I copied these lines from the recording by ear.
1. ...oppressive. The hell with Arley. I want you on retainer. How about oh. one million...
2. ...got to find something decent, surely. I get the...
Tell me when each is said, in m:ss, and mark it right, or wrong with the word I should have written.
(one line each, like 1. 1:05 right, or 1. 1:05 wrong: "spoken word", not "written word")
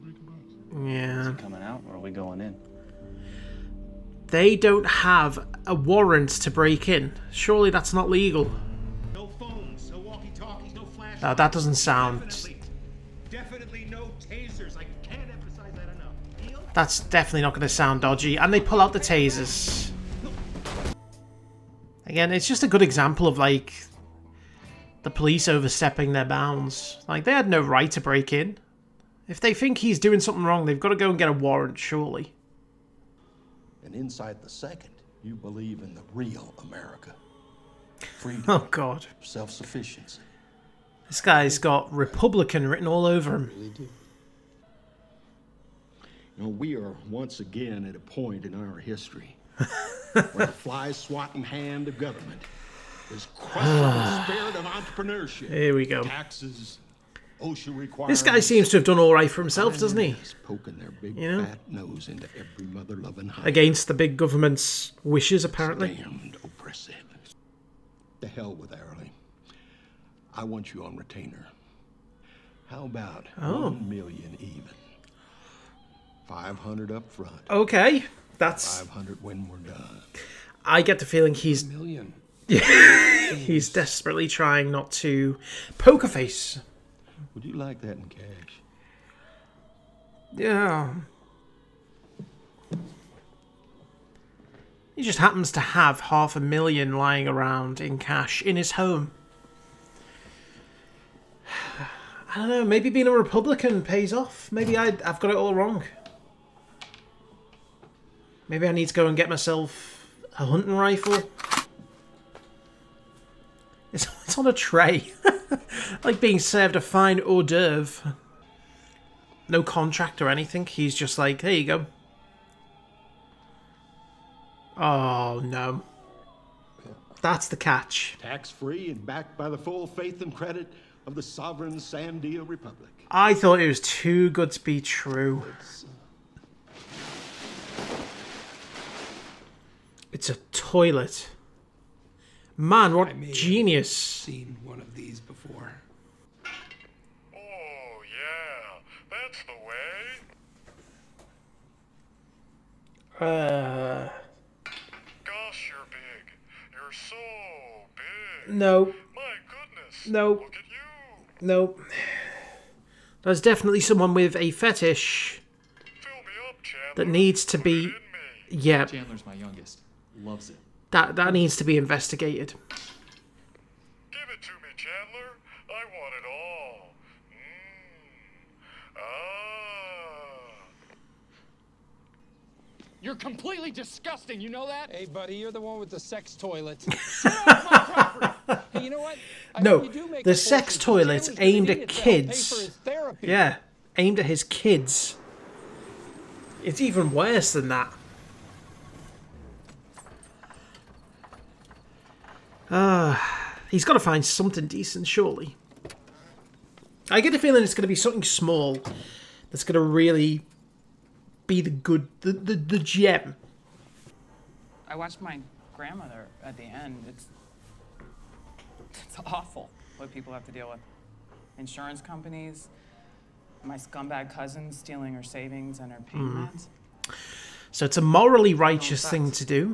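1. 1:06 right
2. 3:23 right.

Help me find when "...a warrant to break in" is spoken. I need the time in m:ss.
0:05.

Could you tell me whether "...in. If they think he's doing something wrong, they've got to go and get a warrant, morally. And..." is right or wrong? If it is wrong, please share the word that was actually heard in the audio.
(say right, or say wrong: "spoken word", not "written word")
wrong: "surely", not "morally".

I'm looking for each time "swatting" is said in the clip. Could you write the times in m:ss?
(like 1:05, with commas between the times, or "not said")
0:50.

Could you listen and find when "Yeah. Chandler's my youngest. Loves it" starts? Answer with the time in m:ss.
2:48.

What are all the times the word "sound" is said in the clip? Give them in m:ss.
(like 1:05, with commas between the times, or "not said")
0:11, 0:17.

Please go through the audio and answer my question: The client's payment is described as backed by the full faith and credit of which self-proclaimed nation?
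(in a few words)
Sovereign Sandia Republic.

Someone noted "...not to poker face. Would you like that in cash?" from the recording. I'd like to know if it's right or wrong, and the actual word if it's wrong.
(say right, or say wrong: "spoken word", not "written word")
right.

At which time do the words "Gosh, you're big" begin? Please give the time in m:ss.
2:35.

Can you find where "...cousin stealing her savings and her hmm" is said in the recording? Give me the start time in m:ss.
3:44.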